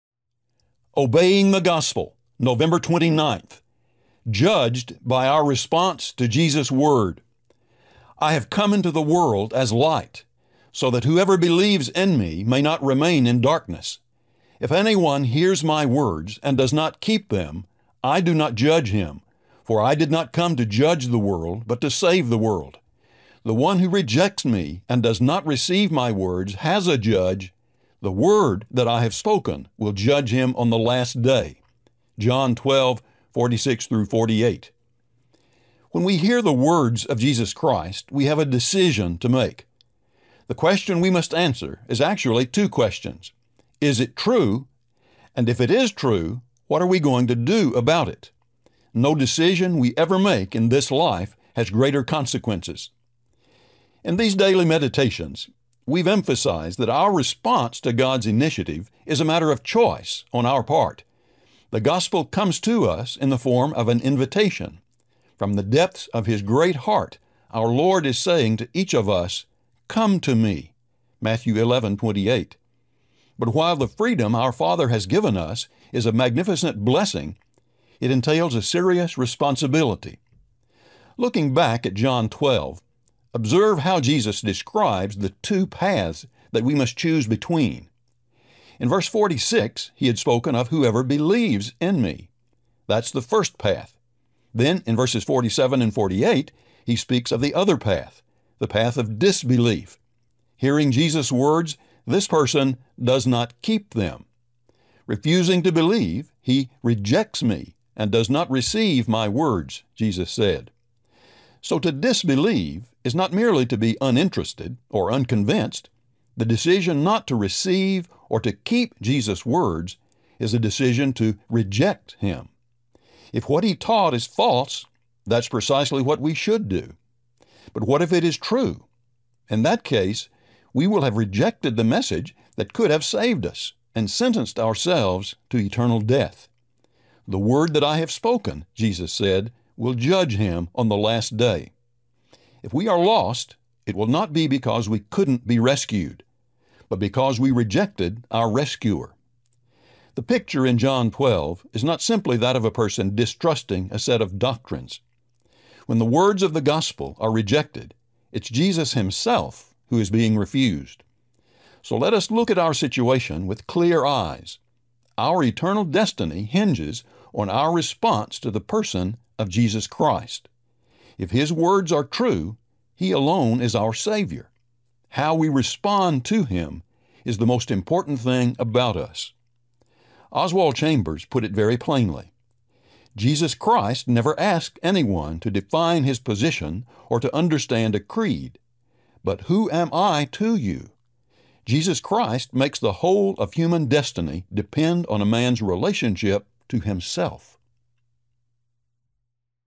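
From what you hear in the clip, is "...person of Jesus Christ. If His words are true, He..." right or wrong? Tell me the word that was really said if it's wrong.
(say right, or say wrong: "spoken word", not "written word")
right.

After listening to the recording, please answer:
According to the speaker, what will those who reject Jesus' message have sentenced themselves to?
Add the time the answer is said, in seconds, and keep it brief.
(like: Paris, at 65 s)
Eternal death, at 135 s.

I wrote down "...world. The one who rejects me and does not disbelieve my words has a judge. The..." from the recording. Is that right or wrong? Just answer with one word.
wrong.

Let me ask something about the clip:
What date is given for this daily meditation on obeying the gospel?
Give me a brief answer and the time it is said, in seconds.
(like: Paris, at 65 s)
November 29th, at 2 s.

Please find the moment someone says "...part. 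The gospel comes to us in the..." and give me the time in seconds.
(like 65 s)
60 s.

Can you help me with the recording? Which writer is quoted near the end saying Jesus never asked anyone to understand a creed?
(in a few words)
Oswald Chambers.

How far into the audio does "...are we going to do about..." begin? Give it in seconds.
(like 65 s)
46 s.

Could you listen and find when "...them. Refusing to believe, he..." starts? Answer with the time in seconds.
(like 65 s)
103 s.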